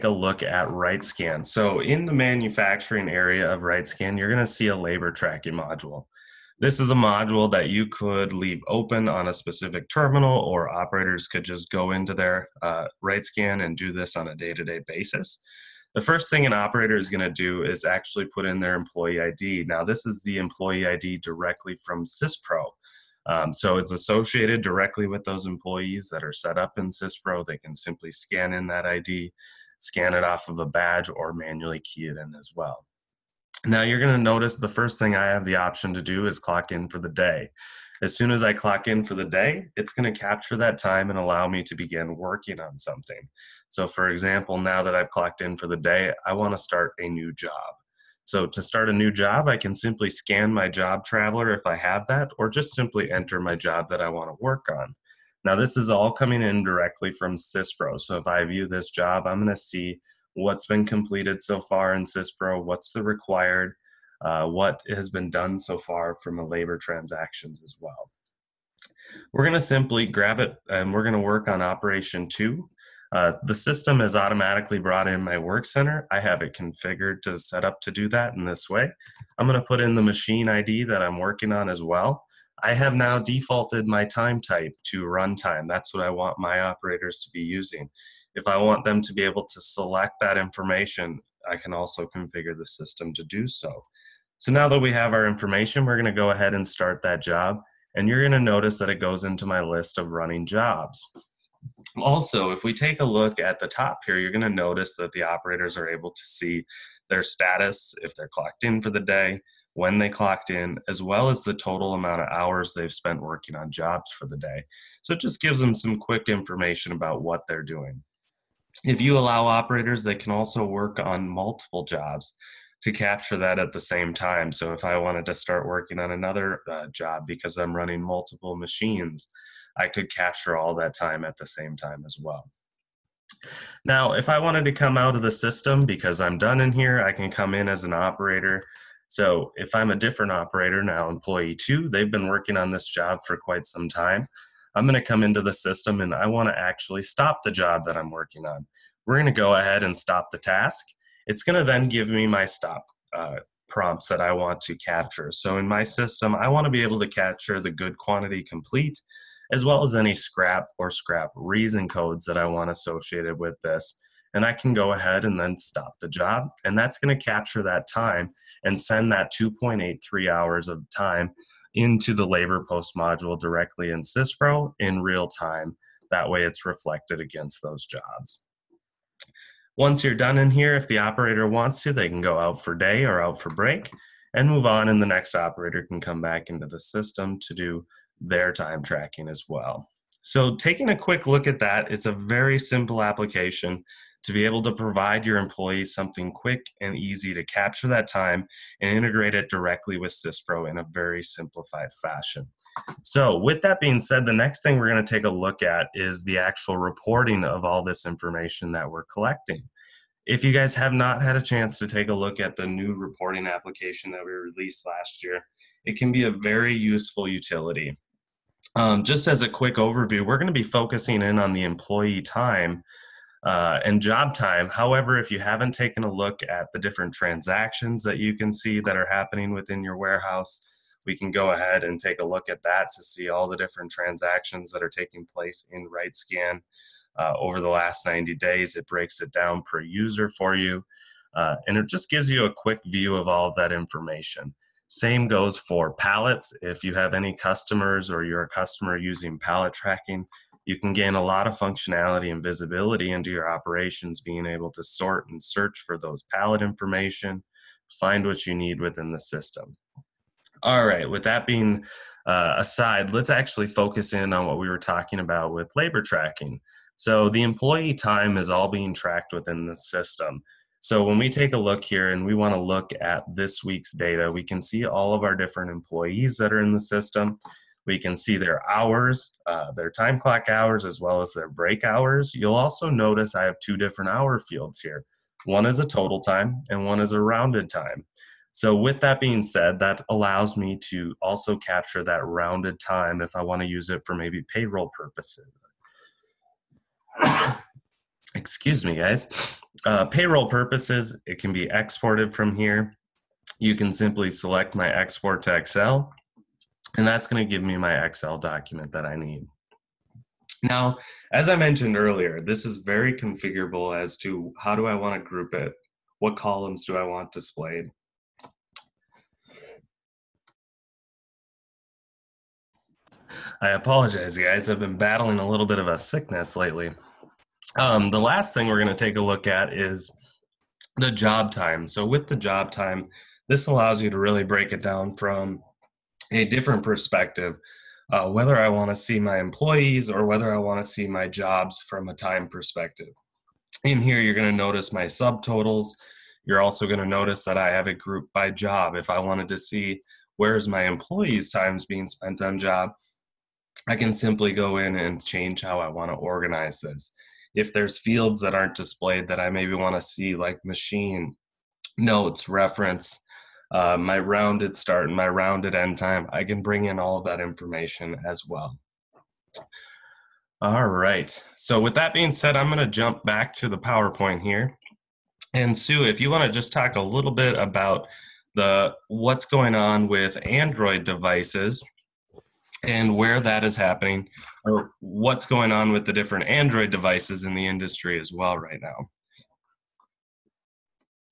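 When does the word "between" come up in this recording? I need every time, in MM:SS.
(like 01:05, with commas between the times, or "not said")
not said.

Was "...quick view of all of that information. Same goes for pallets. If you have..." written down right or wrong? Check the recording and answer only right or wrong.
right.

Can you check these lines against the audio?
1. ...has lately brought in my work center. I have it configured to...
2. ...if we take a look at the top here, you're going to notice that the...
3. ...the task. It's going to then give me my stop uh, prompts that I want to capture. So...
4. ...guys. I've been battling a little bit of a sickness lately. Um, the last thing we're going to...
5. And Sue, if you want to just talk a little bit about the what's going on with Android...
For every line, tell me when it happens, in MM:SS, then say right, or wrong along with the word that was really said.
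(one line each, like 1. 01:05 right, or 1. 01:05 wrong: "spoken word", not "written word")
1. 01:13 wrong: "automatically", not "lately"
2. 01:42 right
3. 02:30 right
4. 05:24 right
5. 06:15 right.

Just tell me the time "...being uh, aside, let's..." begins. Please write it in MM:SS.
04:21.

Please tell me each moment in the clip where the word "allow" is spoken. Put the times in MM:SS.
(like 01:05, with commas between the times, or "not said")
00:41, 01:59, 04:50, 05:33.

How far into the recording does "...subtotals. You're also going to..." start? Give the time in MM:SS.
05:45.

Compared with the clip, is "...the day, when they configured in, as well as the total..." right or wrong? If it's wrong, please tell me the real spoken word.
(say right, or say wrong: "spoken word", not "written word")
wrong: "clocked", not "configured".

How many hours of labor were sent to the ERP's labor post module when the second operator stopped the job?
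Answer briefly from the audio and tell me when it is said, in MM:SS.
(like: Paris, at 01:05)
2.83, at 02:49.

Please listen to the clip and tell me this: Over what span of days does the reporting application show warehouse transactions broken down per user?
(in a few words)
90 days.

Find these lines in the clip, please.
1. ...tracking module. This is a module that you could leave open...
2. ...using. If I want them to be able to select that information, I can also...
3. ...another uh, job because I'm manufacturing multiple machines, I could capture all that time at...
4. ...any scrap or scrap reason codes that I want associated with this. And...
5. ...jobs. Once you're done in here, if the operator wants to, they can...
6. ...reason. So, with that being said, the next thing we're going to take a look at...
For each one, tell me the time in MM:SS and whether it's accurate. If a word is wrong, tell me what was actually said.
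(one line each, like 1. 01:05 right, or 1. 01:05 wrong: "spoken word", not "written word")
1. 00:05 right
2. 01:27 right
3. 02:06 wrong: "running", not "manufacturing"
4. 02:39 right
5. 02:57 right
6. 03:22 wrong: "fashion", not "reason".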